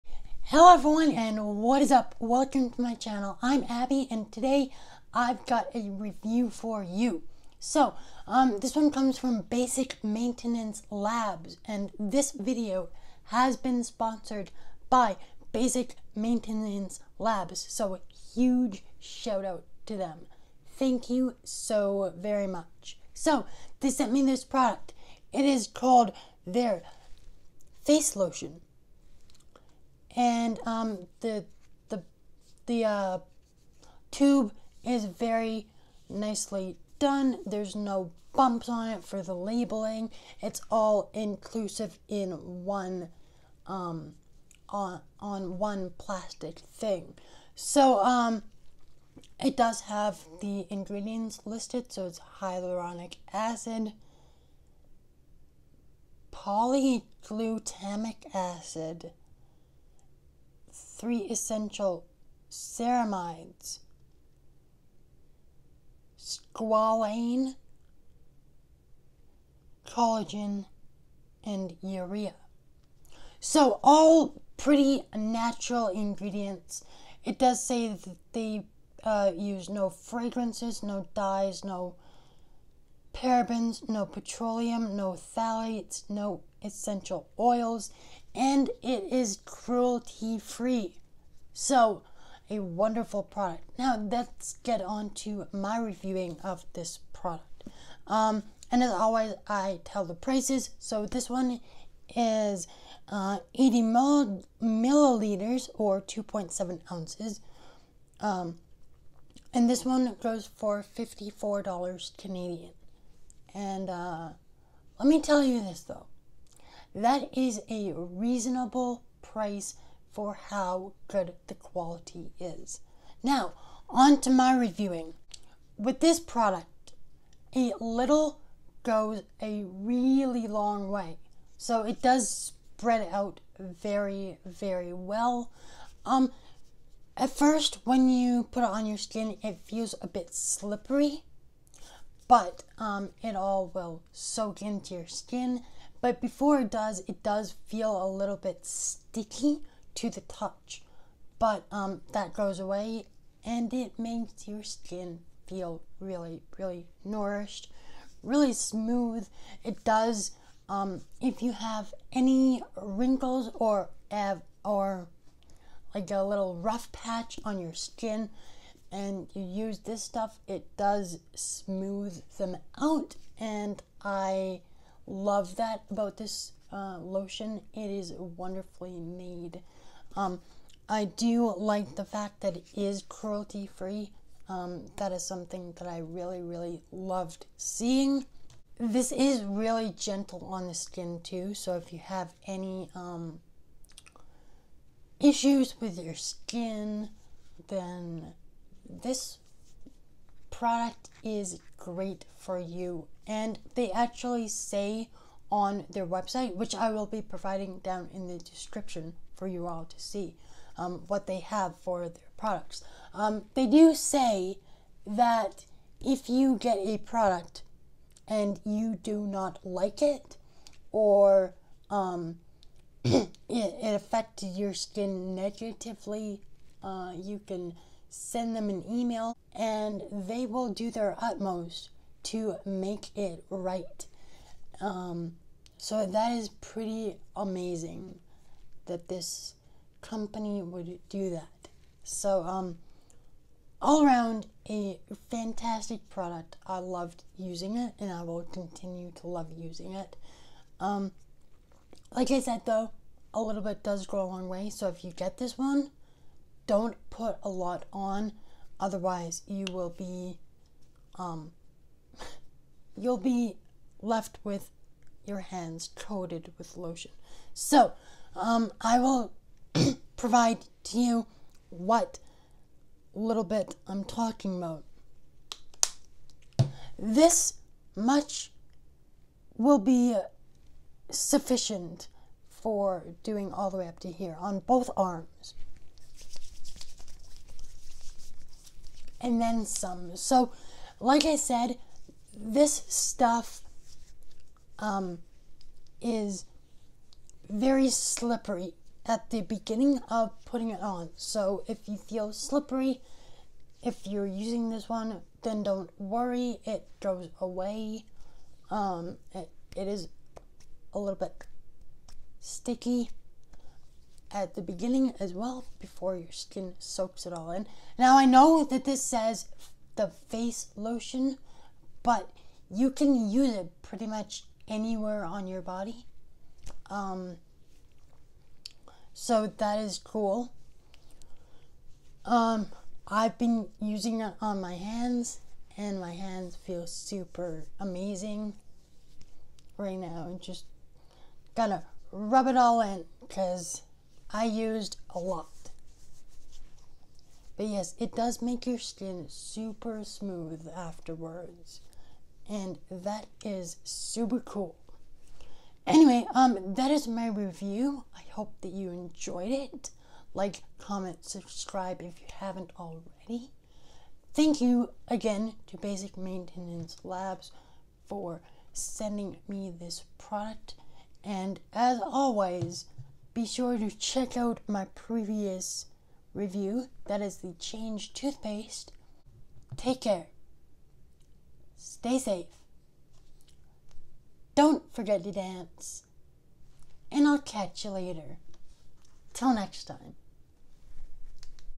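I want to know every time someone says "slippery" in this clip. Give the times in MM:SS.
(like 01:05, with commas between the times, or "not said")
02:20, 04:57, 05:02.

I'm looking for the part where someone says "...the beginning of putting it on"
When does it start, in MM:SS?
04:59.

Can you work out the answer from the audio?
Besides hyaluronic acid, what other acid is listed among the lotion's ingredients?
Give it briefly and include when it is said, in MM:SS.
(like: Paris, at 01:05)
polyglutamic acid, at 00:56.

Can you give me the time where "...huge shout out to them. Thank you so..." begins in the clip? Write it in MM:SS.
00:18.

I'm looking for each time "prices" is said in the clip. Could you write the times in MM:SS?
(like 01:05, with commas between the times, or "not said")
01:40, 01:59.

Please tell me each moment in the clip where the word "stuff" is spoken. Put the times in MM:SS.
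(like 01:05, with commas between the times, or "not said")
02:50, 04:52.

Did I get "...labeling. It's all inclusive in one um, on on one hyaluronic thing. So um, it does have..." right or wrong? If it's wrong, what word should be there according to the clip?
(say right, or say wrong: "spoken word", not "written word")
wrong: "plastic", not "hyaluronic".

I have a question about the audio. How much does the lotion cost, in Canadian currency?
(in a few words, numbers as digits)
$54.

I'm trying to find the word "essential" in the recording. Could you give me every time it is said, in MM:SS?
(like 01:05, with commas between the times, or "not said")
01:01, 01:26.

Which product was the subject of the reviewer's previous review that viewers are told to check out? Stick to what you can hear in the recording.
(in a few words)
the change toothpaste.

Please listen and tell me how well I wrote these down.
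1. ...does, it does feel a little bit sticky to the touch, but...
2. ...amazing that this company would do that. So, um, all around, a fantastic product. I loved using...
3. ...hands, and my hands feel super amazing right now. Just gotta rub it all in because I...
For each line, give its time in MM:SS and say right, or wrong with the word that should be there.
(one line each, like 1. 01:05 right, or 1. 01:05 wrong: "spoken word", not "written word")
1. 02:26 right
2. 03:57 right
3. 05:34 right.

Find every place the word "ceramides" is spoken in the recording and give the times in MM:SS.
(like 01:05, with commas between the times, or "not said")
01:02.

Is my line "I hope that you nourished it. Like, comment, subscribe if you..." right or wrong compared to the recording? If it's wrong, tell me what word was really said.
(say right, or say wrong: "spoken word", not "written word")
wrong: "enjoyed", not "nourished".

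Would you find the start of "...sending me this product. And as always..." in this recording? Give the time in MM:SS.
06:08.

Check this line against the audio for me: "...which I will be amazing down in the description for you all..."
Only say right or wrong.
wrong.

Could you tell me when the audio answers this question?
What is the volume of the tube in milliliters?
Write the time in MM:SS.
01:43.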